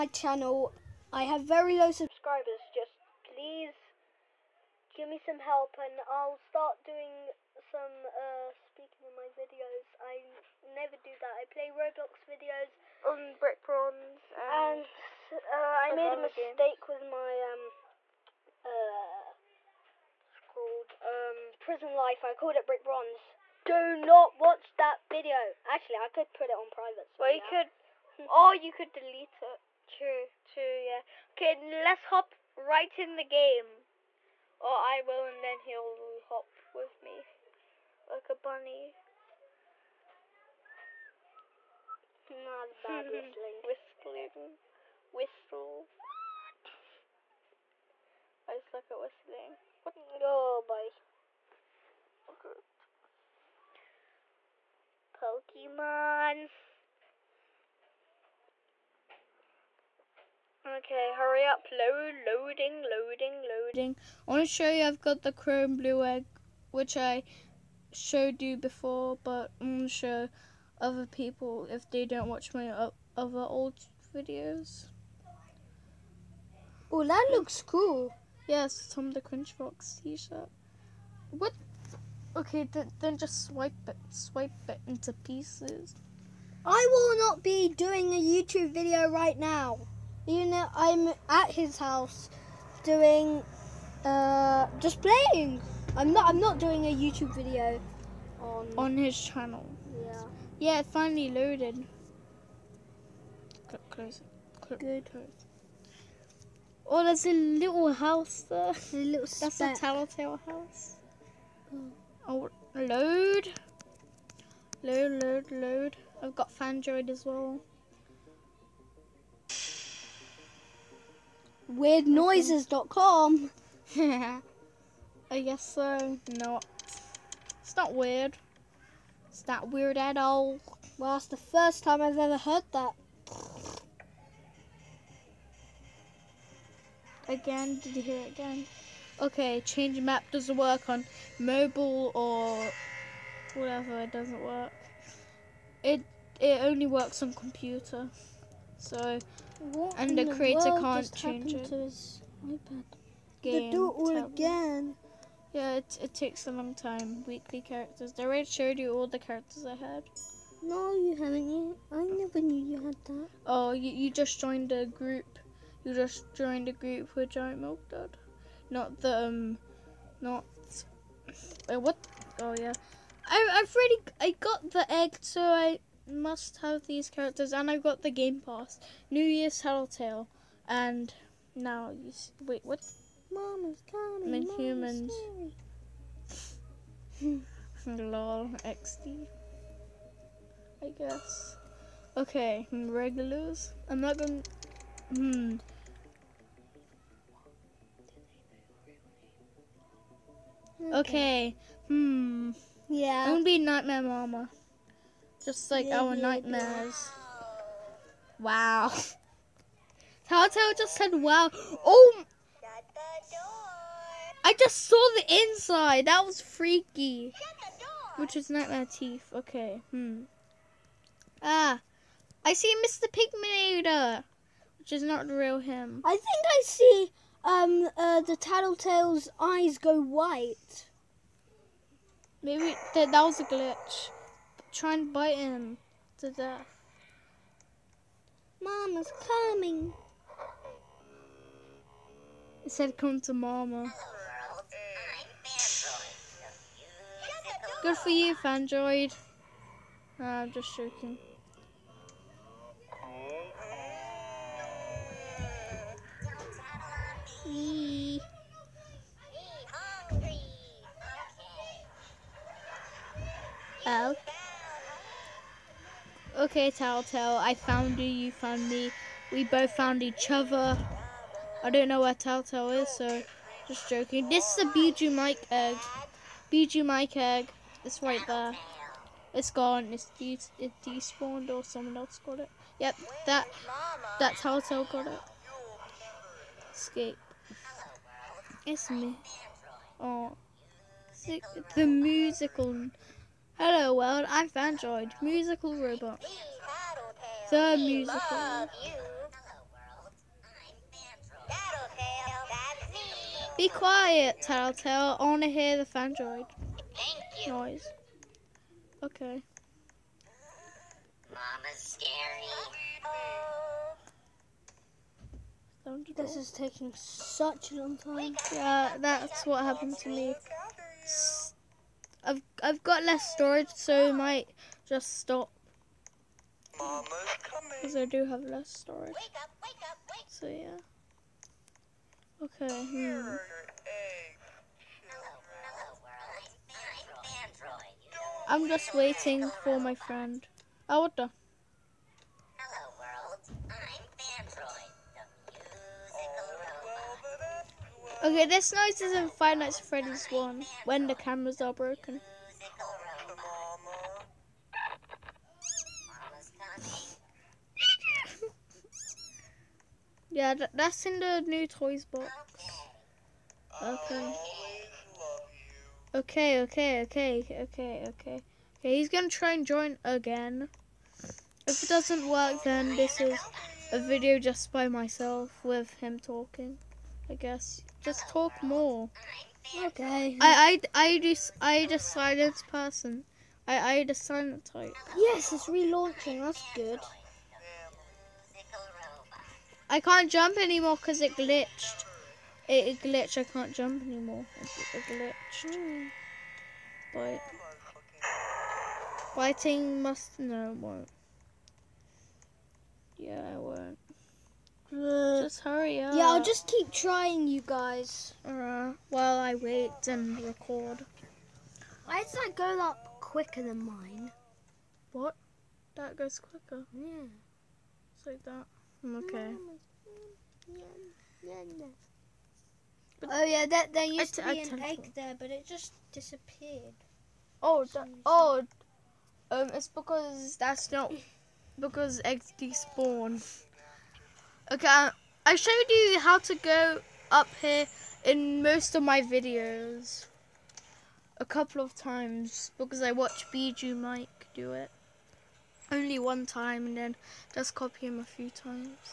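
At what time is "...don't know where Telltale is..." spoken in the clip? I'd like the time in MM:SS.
04:31.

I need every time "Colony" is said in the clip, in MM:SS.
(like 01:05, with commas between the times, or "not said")
not said.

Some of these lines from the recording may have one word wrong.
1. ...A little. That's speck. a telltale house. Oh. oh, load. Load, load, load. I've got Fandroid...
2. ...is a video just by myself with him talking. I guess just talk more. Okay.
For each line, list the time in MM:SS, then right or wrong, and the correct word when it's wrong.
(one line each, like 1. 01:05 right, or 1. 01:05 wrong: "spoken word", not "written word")
1. 01:48 right
2. 06:13 right.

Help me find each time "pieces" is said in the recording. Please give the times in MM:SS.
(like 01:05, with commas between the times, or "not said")
01:25.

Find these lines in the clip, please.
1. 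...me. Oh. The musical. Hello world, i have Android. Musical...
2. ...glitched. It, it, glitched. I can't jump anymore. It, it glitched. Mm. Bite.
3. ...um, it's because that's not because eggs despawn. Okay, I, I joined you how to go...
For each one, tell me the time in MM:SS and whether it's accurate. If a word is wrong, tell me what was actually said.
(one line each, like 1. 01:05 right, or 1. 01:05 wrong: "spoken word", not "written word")
1. 04:48 right
2. 06:31 right
3. 07:09 wrong: "showed", not "joined".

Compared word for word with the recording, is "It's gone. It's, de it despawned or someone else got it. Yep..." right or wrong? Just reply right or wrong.
right.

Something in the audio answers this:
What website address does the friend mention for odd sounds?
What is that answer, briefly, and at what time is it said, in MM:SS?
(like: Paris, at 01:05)
weirdnoises.com, at 02:01.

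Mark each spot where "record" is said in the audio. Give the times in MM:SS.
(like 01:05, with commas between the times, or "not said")
06:50.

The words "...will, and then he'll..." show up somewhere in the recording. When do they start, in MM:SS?
00:35.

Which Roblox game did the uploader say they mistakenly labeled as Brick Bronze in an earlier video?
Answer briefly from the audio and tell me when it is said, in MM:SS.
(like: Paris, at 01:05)
Prison Life, at 00:21.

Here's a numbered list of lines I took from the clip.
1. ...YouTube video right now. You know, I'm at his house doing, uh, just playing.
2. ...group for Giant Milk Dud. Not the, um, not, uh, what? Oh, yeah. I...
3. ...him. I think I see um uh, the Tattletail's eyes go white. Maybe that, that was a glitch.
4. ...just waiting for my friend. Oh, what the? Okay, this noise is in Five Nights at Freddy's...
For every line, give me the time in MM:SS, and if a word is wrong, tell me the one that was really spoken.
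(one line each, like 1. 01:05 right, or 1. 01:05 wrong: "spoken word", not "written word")
1. 01:28 right
2. 02:46 right
3. 03:45 right
4. 05:38 right.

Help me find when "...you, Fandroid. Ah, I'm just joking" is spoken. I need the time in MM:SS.
04:08.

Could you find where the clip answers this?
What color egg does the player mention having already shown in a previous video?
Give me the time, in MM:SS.
01:05.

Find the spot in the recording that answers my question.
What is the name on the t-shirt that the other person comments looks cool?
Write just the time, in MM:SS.
01:18.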